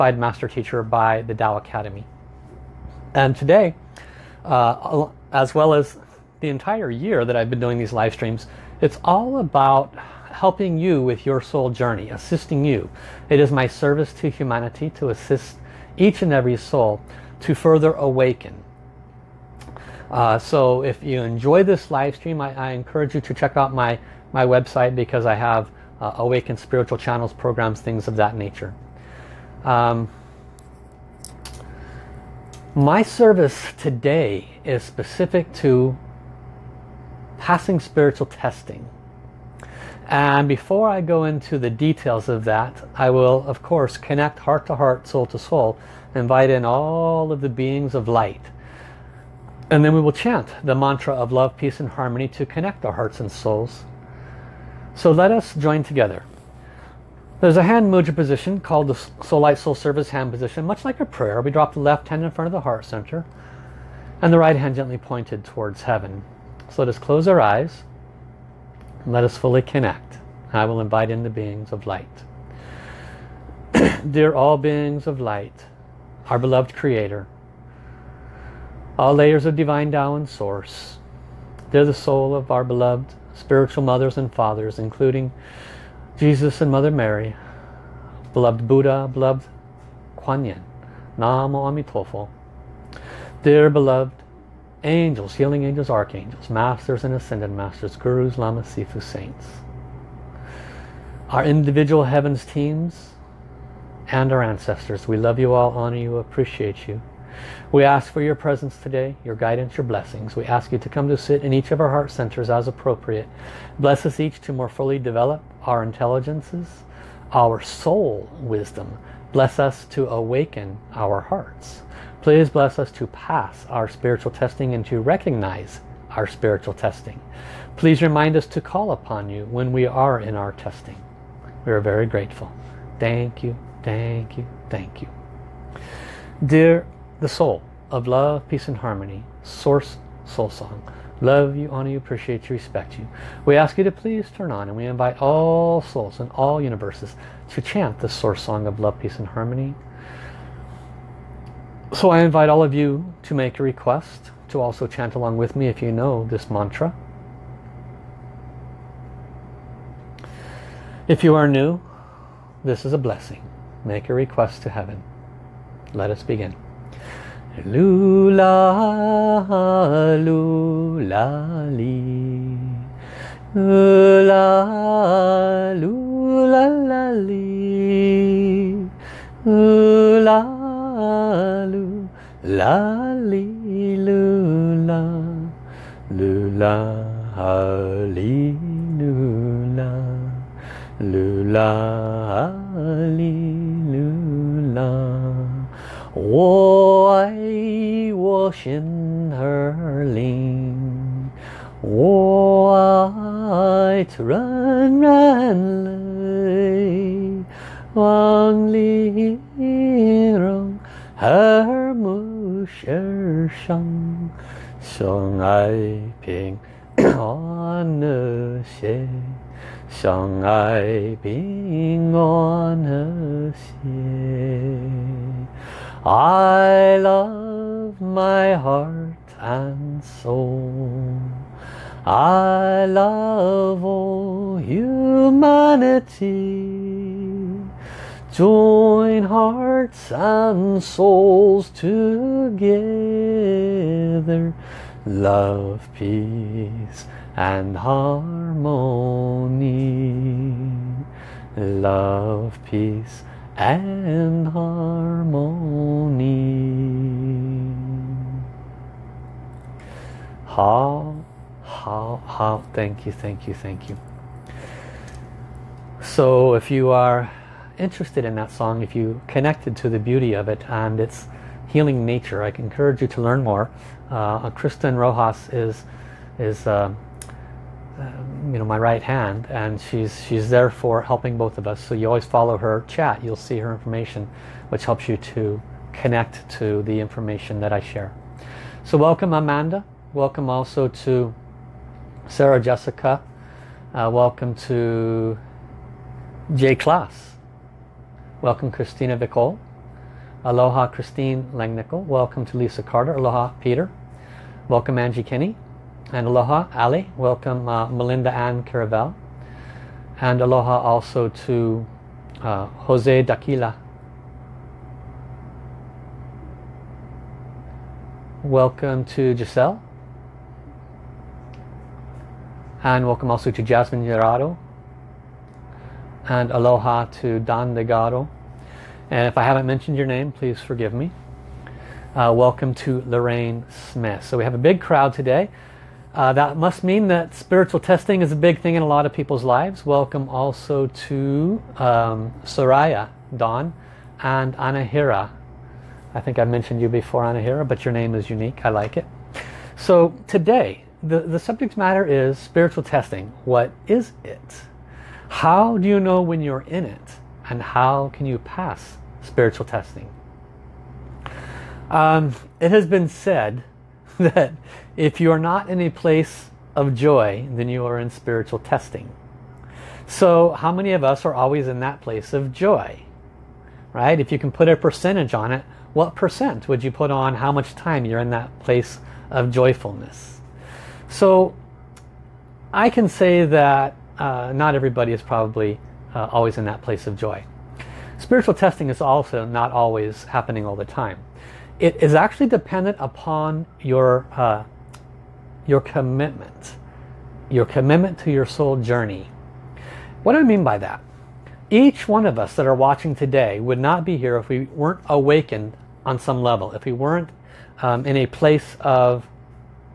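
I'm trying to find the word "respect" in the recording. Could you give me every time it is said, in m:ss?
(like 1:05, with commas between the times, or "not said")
2:22.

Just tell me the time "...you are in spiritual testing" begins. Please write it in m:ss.
6:07.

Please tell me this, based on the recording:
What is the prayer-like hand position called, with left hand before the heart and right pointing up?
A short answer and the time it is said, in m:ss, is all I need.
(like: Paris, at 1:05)
Soul Light Soul Service hand position, at 0:59.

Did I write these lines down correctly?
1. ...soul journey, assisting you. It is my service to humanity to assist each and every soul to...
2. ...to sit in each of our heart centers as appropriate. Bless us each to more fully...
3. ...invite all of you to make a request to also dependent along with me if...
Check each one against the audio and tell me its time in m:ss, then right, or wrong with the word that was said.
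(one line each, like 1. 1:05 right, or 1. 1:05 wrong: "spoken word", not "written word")
1. 0:11 right
2. 1:51 right
3. 2:32 wrong: "chant", not "dependent".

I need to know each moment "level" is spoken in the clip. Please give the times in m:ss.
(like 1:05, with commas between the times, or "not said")
6:46.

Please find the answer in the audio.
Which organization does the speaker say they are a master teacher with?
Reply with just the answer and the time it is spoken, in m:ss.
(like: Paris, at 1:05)
Tao Academy, at 0:01.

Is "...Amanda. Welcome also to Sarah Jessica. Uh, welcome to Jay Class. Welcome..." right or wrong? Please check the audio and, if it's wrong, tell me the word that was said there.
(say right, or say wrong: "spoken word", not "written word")
right.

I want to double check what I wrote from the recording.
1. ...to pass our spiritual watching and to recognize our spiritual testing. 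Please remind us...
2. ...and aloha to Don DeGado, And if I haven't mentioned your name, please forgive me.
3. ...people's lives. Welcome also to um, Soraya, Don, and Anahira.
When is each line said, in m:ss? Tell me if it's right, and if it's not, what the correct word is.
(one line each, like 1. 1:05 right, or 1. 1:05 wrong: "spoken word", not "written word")
1. 2:02 wrong: "testing", not "watching"
2. 5:26 right
3. 5:39 right.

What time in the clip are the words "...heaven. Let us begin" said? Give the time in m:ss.
2:44.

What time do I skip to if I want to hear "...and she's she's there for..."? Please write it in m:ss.
4:39.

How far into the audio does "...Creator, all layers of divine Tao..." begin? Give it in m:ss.
1:16.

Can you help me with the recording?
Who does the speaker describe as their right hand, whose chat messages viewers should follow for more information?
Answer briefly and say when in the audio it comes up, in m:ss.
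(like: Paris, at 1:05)
Kristen Rojas, at 4:34.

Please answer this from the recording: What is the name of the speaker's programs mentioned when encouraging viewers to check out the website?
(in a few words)
Awaken Spiritual Channels.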